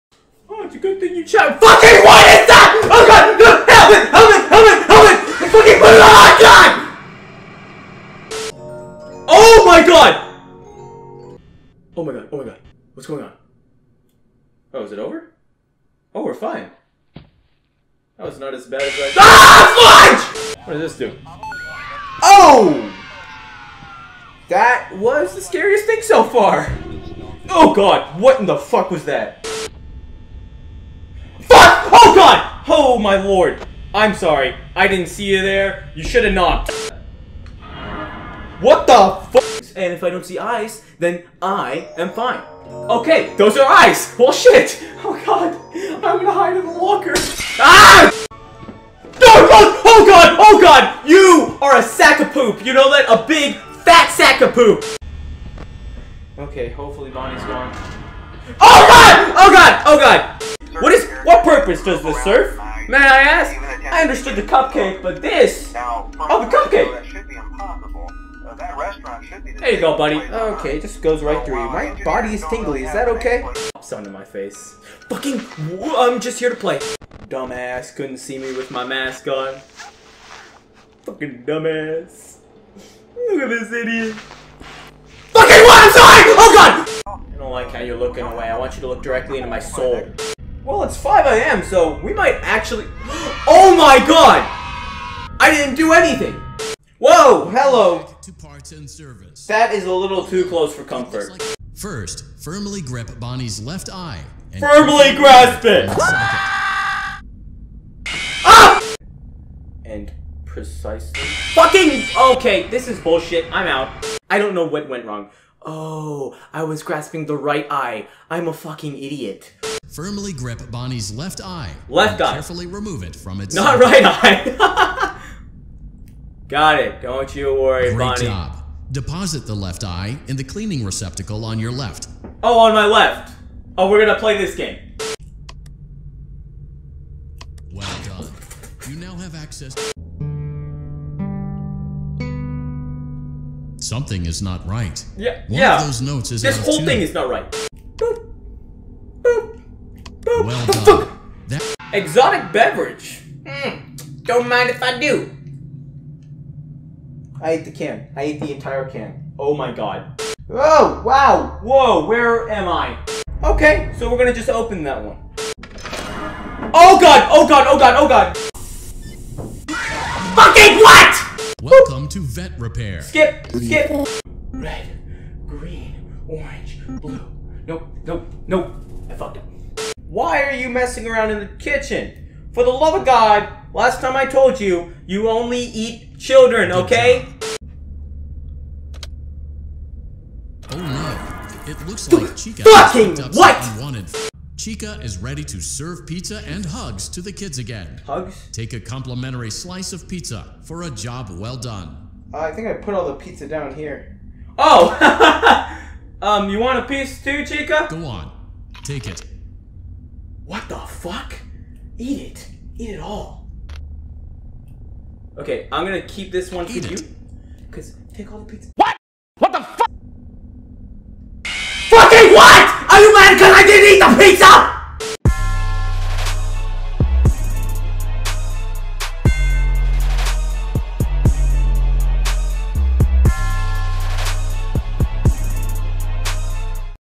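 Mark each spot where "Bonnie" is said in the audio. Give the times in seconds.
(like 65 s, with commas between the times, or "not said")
57 s, 103 s, 120 s, 128 s.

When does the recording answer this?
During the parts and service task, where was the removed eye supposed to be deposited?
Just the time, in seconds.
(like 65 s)
130 s.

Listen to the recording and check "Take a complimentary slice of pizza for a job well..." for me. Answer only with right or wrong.
right.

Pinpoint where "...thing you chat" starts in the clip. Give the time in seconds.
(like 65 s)
1 s.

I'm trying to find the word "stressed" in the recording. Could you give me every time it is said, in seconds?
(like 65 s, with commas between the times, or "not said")
not said.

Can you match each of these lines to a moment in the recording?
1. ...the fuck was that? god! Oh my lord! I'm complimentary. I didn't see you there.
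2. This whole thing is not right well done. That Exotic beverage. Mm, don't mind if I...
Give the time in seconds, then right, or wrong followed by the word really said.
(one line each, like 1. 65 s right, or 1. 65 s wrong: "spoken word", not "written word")
1. 28 s wrong: "sorry", not "complimentary"
2. 146 s right.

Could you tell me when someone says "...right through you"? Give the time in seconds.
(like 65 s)
71 s.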